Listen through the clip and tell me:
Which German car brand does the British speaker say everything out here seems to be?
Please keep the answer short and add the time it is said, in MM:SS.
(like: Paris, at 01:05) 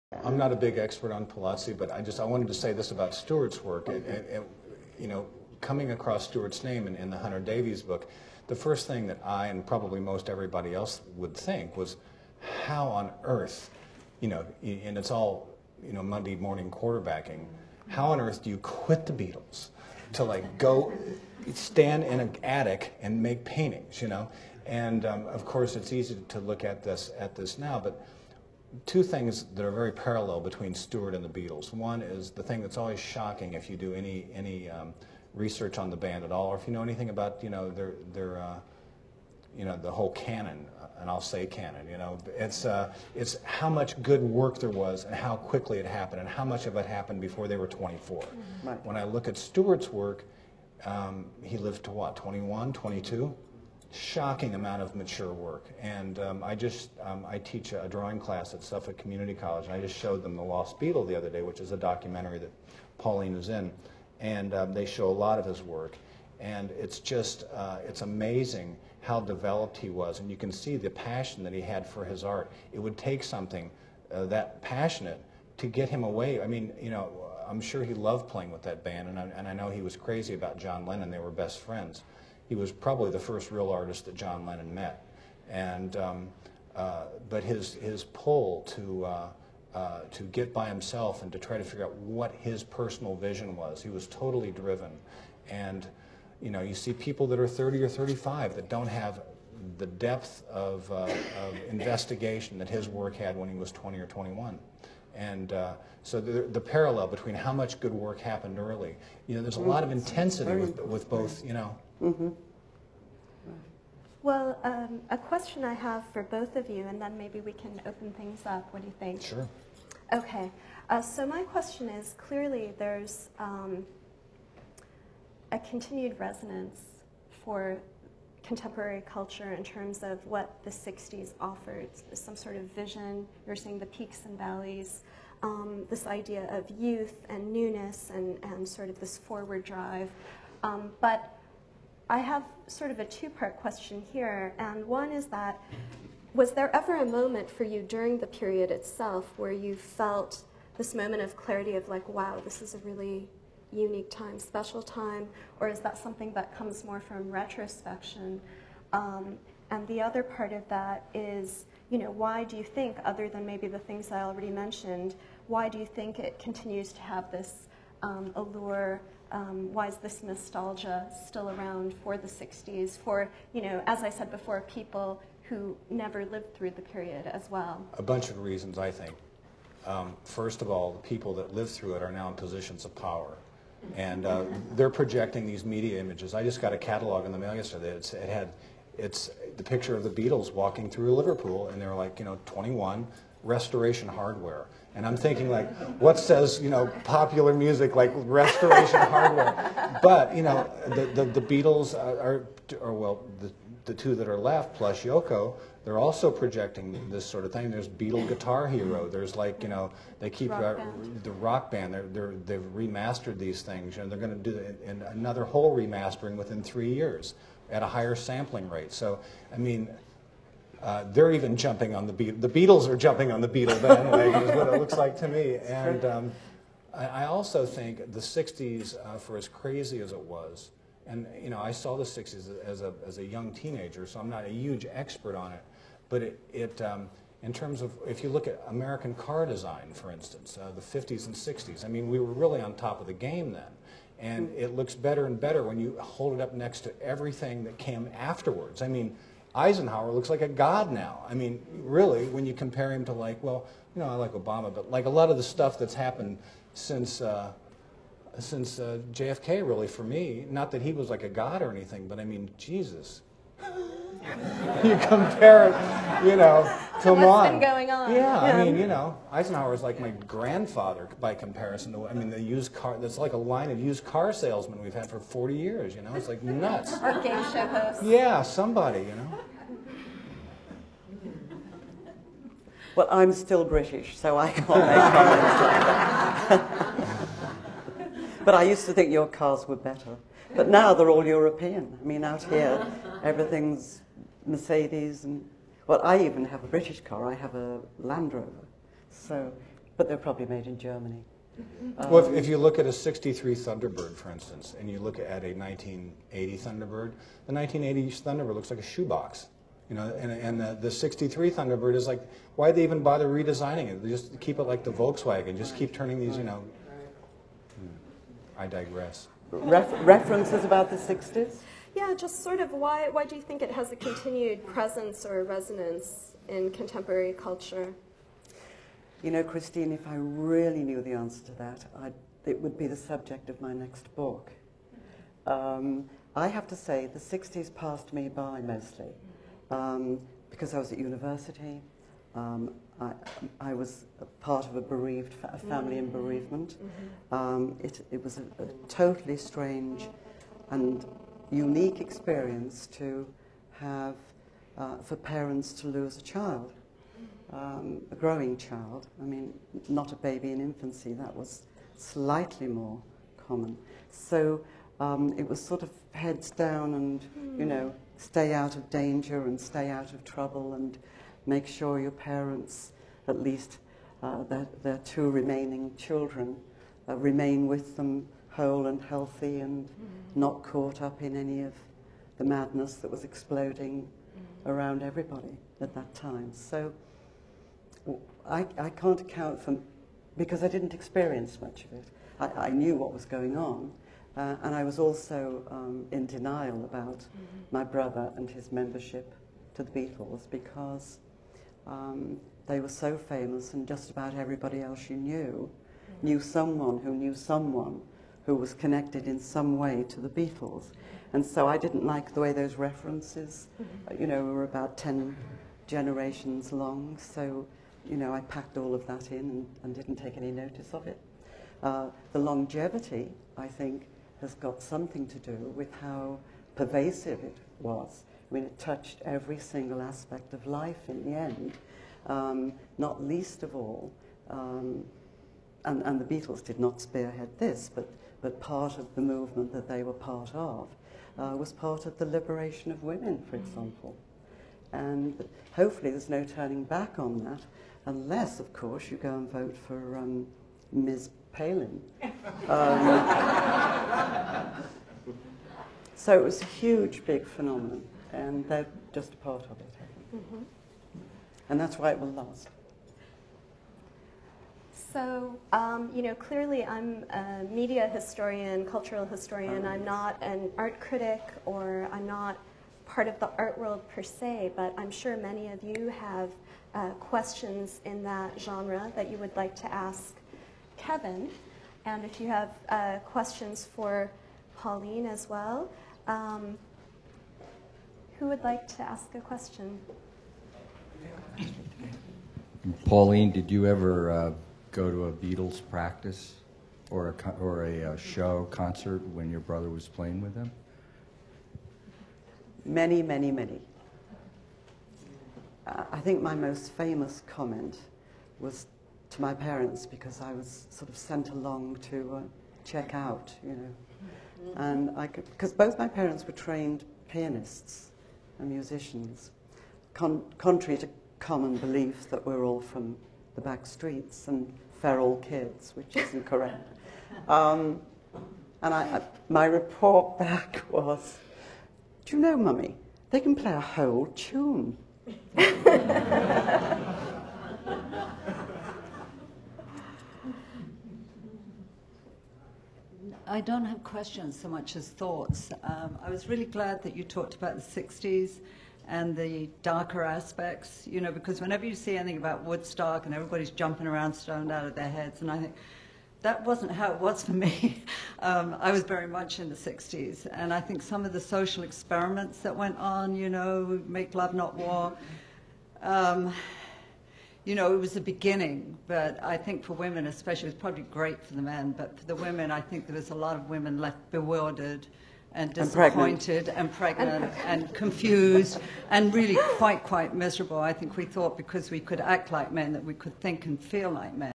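Mercedes, at 04:54.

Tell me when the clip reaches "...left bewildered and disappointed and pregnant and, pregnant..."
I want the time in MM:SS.
09:33.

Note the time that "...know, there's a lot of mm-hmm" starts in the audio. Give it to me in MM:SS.
01:49.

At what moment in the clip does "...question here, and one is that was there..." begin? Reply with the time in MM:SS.
02:23.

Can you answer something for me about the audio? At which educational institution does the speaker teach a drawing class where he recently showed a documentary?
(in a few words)
Suffolk Community College.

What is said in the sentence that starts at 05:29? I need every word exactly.
You know, Christine, if I really knew the answer to that, I'd, it would be the subject of my next book.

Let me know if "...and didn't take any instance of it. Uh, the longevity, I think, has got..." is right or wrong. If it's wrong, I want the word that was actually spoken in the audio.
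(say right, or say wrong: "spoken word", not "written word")
wrong: "notice", not "instance".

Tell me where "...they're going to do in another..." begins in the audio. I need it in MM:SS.
03:34.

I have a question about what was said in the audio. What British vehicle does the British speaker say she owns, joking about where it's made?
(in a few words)
Land Rover.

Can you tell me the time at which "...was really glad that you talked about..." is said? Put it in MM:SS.
09:06.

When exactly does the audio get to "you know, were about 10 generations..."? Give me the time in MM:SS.
06:54.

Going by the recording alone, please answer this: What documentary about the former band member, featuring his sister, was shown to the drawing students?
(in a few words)
The Lost Beatle.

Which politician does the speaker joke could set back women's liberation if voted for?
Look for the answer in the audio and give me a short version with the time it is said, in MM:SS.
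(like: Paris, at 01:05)
Ms. Palin, at 07:30.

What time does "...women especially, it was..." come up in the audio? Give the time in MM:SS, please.
09:29.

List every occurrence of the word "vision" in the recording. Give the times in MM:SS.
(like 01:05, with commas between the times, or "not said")
01:33, 02:12.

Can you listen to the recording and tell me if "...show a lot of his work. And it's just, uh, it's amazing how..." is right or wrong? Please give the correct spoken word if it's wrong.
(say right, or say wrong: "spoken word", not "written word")
right.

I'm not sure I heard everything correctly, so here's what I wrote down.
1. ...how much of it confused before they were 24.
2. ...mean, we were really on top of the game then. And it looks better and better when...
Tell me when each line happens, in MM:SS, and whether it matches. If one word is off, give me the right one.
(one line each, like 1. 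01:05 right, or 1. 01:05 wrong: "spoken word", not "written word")
1. 00:46 wrong: "happened", not "confused"
2. 04:01 right.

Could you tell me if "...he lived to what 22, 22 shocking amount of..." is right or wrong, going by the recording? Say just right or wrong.
wrong.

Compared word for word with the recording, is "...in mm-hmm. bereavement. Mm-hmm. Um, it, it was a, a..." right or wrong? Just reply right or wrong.
right.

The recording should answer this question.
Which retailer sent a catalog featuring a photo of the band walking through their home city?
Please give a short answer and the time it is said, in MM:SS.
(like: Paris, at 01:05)
Restoration Hardware, at 03:13.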